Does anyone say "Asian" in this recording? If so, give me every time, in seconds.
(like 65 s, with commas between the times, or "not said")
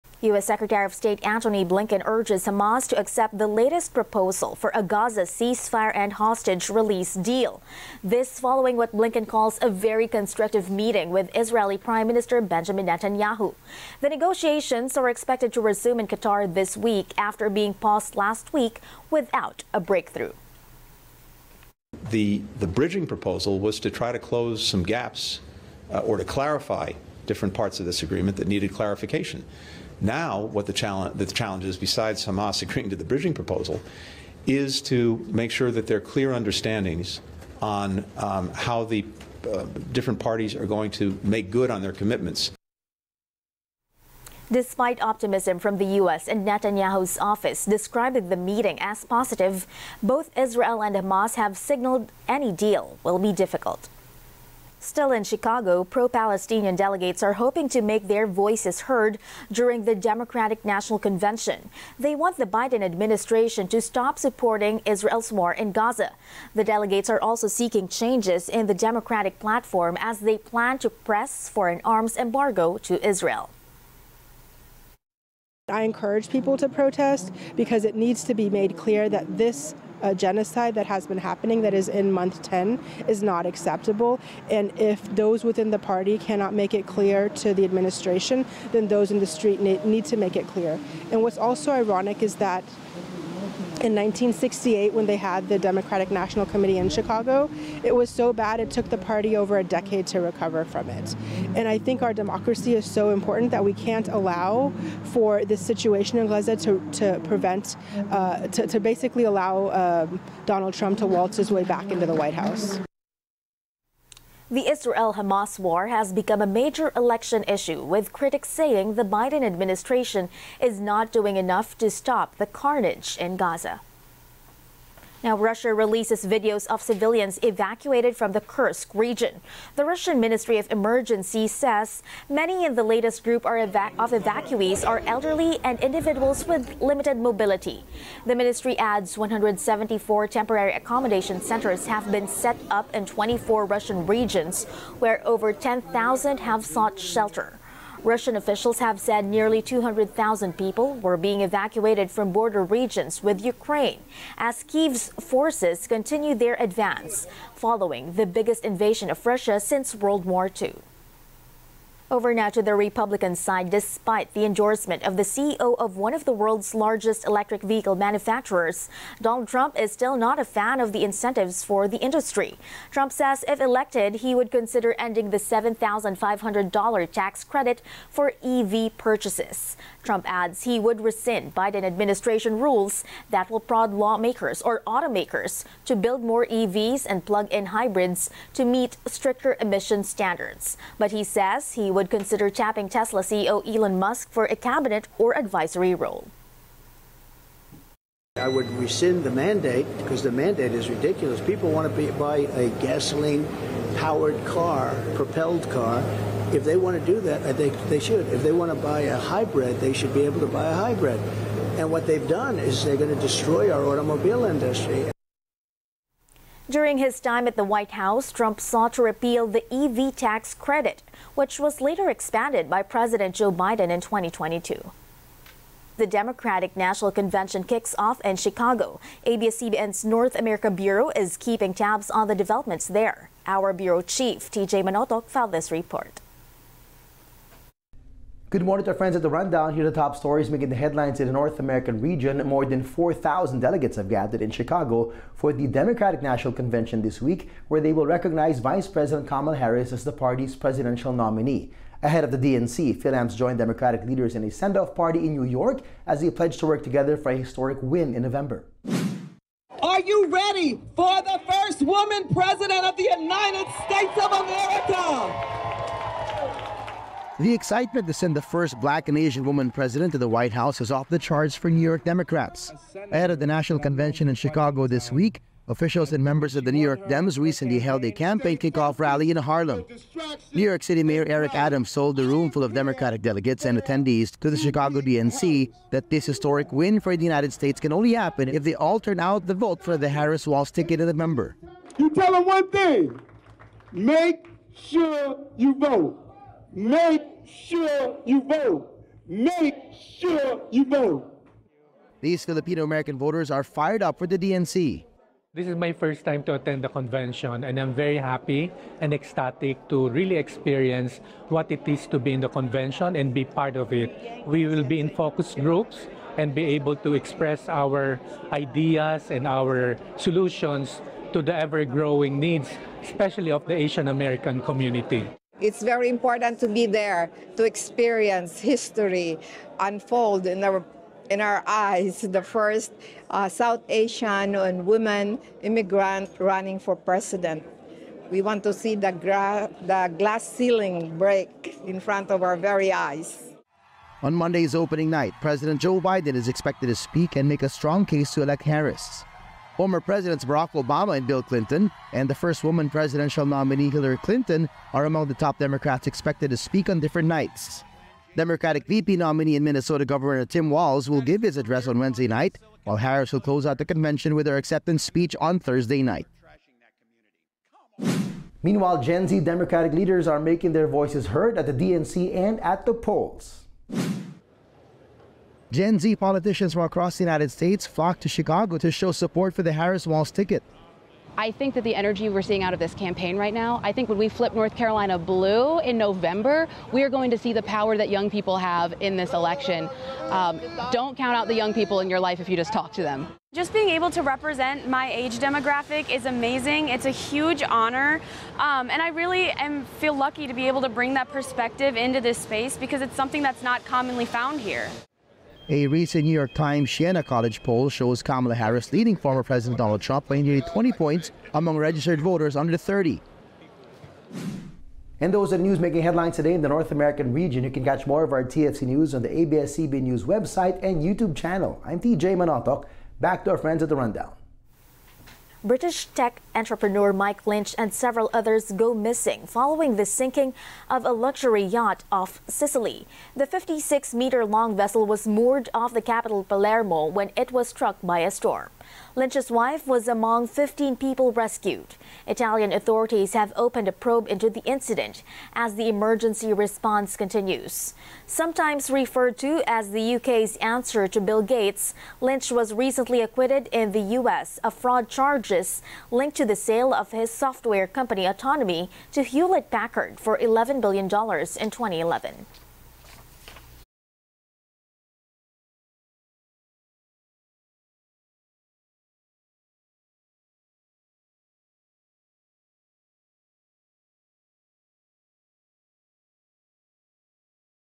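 269 s, 323 s, 333 s.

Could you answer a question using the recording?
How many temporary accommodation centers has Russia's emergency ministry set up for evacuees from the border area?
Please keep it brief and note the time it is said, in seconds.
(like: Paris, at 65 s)
174, at 139 s.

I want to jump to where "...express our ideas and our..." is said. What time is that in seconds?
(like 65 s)
317 s.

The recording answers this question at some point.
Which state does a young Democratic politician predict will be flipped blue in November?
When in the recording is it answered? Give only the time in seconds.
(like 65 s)
384 s.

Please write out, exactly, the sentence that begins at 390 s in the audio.
Um, don't count out the young people in your life if you just talk to them.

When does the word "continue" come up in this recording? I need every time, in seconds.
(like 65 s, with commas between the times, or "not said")
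155 s, 447 s.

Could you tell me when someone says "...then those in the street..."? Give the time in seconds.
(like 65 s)
88 s.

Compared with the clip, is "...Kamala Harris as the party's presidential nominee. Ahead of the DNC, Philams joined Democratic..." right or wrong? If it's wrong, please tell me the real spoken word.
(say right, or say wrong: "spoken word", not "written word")
right.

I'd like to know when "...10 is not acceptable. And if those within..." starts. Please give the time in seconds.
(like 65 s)
82 s.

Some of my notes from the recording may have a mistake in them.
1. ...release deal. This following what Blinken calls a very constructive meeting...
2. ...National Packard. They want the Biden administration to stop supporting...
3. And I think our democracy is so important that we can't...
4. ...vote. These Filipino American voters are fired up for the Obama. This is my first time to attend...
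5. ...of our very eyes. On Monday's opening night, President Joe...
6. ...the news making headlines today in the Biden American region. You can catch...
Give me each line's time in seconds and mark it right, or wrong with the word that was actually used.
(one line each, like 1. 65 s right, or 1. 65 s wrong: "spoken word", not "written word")
1. 6 s right
2. 60 s wrong: "Convention", not "Packard"
3. 101 s right
4. 300 s wrong: "DNC", not "Obama"
5. 342 s right
6. 415 s wrong: "North", not "Biden".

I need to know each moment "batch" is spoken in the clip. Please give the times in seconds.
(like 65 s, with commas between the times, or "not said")
not said.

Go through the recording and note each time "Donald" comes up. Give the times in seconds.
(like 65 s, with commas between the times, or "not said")
110 s, 169 s, 409 s.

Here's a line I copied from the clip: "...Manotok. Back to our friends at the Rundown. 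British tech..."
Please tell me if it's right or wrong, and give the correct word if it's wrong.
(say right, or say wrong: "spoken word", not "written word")
right.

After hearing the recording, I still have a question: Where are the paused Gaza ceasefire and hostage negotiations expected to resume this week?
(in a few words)
Qatar.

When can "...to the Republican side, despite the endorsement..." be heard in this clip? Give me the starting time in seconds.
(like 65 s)
162 s.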